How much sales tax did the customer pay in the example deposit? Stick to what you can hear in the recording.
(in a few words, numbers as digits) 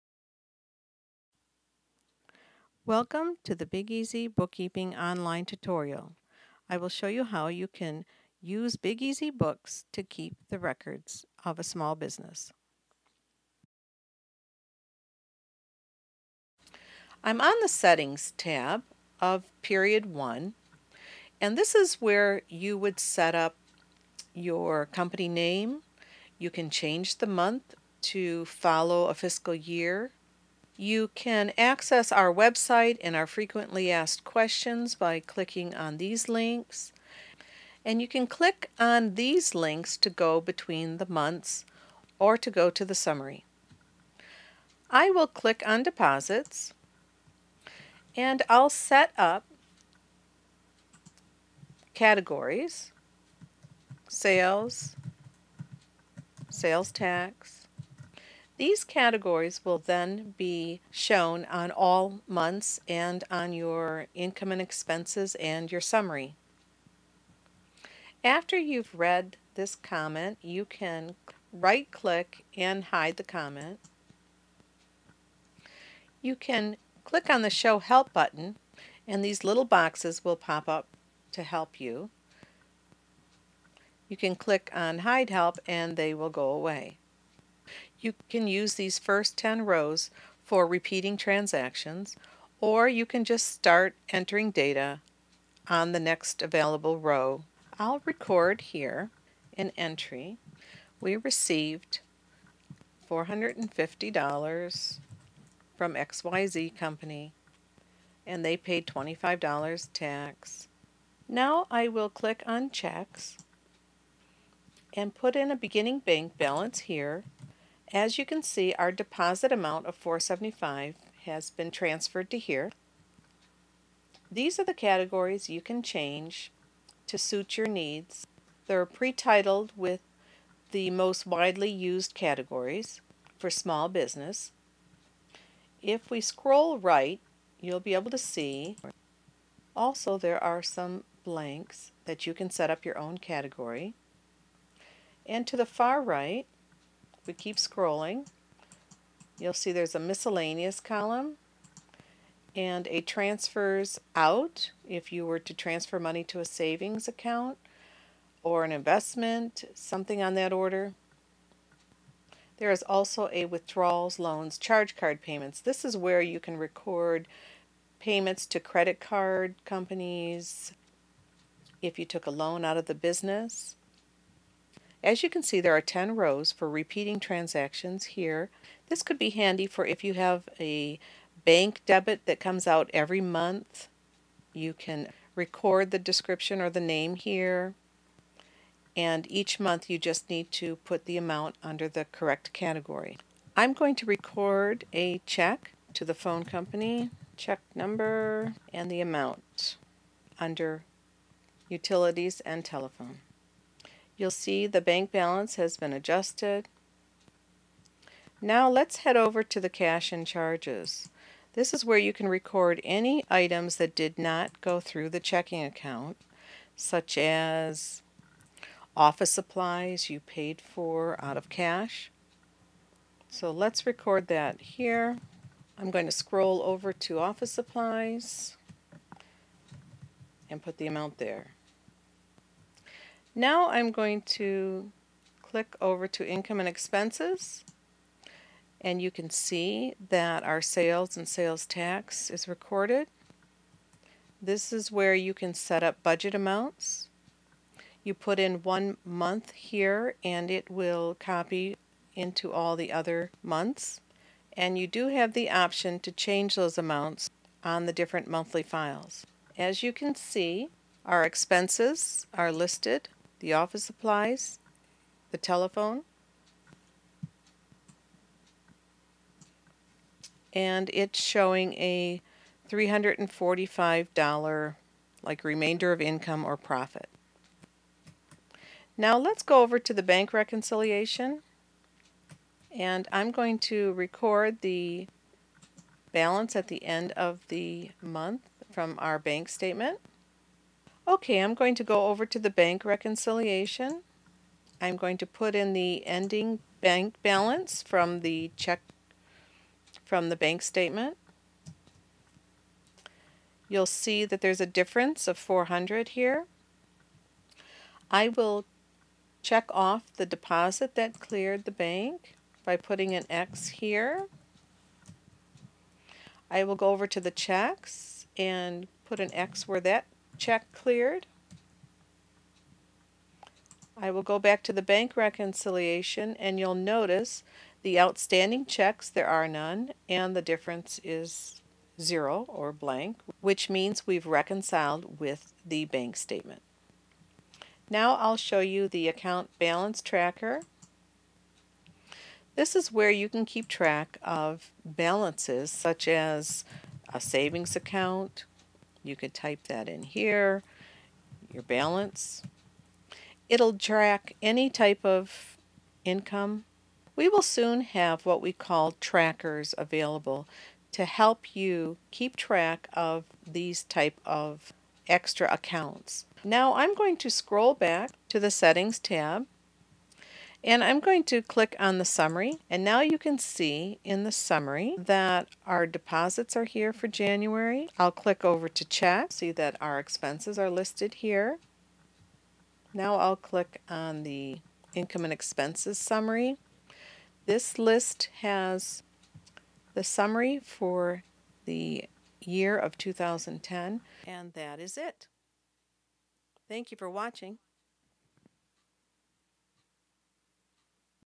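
$25.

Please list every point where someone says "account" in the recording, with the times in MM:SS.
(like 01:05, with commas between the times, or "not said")
02:37, 03:35, 05:39, 05:47, 06:05.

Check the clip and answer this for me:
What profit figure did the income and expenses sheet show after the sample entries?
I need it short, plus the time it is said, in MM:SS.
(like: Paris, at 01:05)
$345, at 04:32.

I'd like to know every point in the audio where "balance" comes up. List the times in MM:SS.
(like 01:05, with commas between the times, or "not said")
01:56, 03:25, 04:46, 04:57, 05:39, 05:44, 05:51.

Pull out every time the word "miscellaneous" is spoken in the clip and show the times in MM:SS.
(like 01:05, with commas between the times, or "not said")
02:29.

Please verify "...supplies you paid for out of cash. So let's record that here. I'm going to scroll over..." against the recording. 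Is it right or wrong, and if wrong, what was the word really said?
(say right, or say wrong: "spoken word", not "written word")
right.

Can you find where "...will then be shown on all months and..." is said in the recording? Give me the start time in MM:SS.
00:59.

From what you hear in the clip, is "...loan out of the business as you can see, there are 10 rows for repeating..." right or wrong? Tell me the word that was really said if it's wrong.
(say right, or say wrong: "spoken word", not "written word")
right.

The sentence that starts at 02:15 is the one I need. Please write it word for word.
If we scroll right, you'll be able to see also there are some blanks that you can set up your own category.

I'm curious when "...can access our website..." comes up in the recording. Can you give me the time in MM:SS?
00:31.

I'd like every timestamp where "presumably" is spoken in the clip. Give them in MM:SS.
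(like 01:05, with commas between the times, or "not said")
not said.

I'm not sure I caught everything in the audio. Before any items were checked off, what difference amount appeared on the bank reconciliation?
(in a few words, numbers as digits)
400.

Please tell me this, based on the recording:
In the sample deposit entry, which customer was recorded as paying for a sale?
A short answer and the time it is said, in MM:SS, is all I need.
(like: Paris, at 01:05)
XYZ Company, at 01:45.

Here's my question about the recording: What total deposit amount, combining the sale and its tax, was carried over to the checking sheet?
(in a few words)
475.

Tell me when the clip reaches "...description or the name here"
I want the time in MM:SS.
03:05.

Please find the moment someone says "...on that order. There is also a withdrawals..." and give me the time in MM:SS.
02:40.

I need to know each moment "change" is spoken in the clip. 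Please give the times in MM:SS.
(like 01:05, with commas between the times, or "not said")
00:26, 02:05, 04:16.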